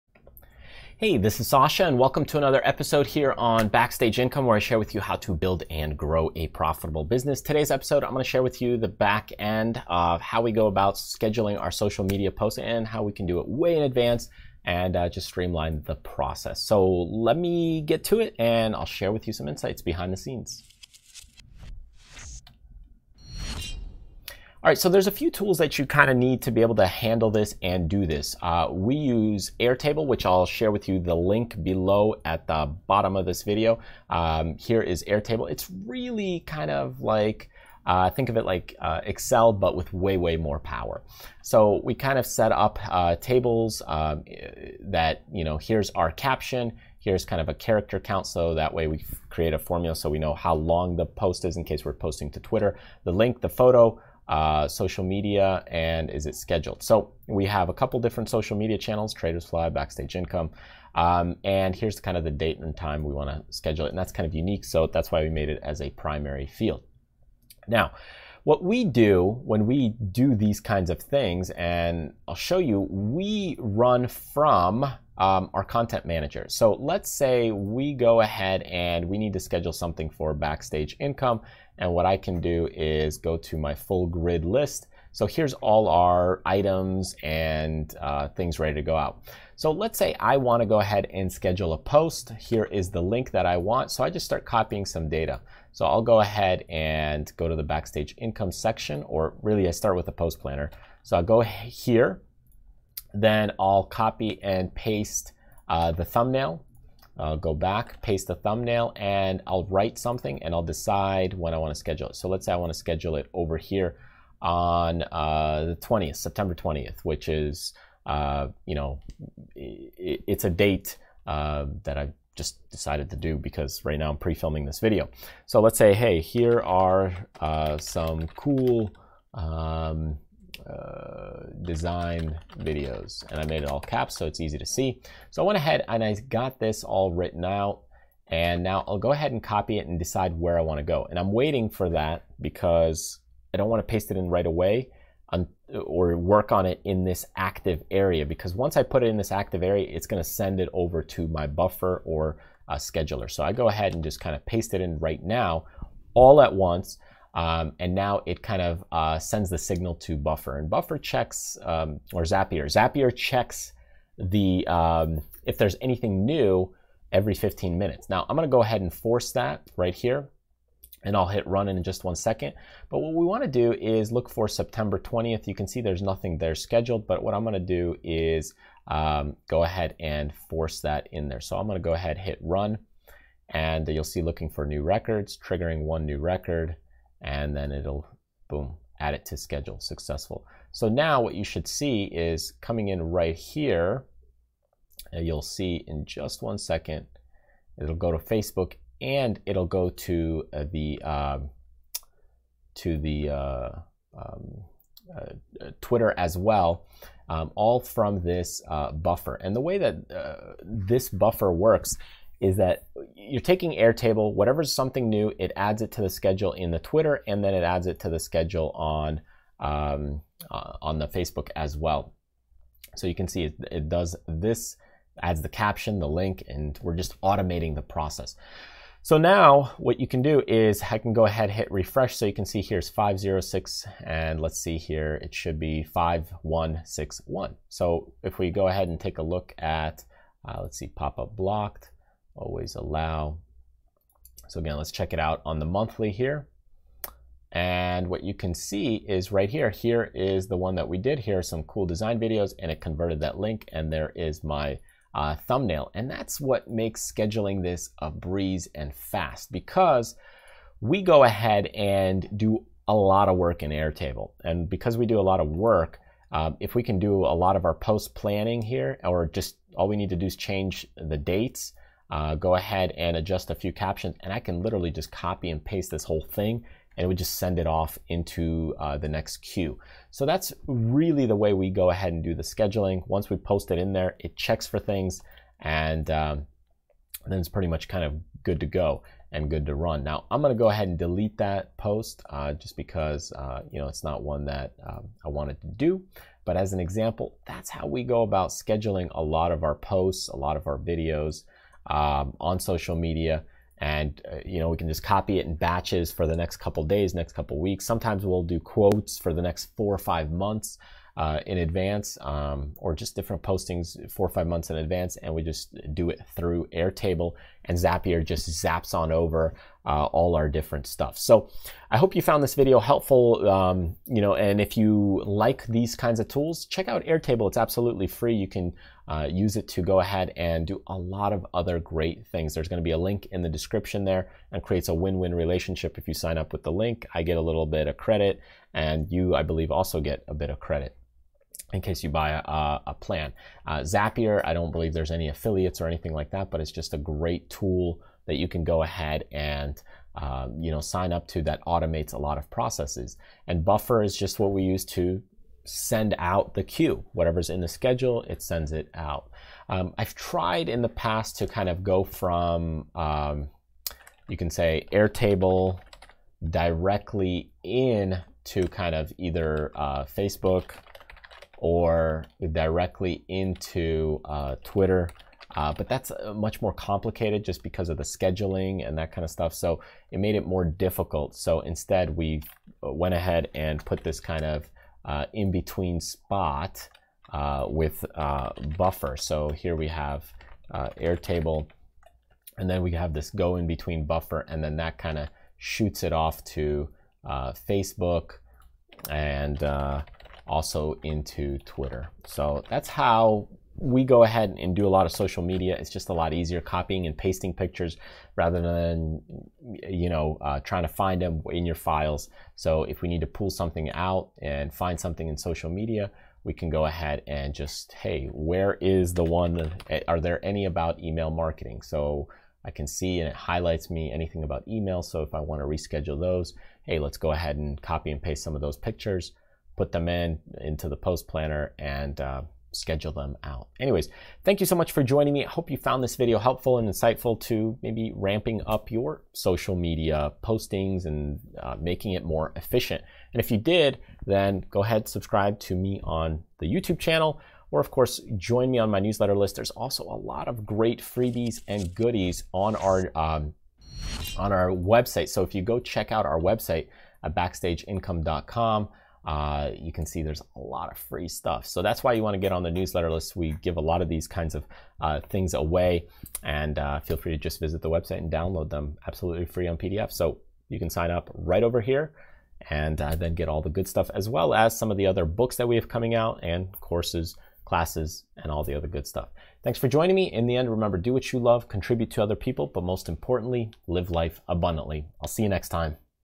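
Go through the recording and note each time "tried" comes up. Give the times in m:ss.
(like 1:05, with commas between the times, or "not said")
6:00.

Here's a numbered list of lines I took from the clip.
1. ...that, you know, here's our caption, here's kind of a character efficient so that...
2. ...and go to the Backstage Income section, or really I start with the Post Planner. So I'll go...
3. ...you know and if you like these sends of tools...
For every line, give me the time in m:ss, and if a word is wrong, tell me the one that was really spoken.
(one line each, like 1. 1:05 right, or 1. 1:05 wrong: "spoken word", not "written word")
1. 0:44 wrong: "count", not "efficient"
2. 1:36 right
3. 5:24 wrong: "kinds", not "sends".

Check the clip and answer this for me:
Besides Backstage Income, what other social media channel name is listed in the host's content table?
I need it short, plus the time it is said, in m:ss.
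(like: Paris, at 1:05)
Tradersfly, at 0:59.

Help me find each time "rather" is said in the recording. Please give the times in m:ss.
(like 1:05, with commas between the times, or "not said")
6:48.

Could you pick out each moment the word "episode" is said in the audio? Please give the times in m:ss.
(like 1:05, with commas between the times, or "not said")
0:02, 0:07.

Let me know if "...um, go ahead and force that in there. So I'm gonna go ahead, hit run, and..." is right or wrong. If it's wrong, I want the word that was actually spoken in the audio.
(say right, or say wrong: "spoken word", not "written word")
right.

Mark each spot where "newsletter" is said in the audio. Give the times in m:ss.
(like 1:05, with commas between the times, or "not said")
7:28, 7:42.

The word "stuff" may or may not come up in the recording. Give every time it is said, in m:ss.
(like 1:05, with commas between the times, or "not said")
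5:20, 6:19, 7:41, 7:53, 7:59.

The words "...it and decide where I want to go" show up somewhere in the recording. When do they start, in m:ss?
2:19.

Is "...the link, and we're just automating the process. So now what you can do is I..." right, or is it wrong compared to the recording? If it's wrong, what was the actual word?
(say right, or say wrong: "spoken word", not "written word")
right.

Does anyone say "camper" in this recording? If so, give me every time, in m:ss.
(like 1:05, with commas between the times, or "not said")
not said.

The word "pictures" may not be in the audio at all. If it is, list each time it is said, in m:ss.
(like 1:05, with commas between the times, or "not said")
6:47, 7:08.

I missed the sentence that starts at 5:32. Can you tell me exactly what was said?
There's going to be a link in the description there and creates a win win relationship.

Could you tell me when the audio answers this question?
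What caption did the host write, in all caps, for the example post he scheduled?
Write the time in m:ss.
2:06.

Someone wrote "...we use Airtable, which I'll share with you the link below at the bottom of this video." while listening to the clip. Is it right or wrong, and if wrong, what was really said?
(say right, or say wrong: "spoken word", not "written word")
right.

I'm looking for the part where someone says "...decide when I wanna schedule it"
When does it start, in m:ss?
1:50.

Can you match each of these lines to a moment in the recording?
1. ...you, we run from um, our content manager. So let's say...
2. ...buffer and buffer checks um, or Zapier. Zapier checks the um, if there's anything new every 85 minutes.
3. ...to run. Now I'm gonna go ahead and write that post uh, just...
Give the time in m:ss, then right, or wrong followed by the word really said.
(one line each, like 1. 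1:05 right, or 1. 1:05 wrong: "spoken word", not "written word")
1. 1:12 right
2. 2:40 wrong: "15", not "85"
3. 4:49 wrong: "delete", not "write".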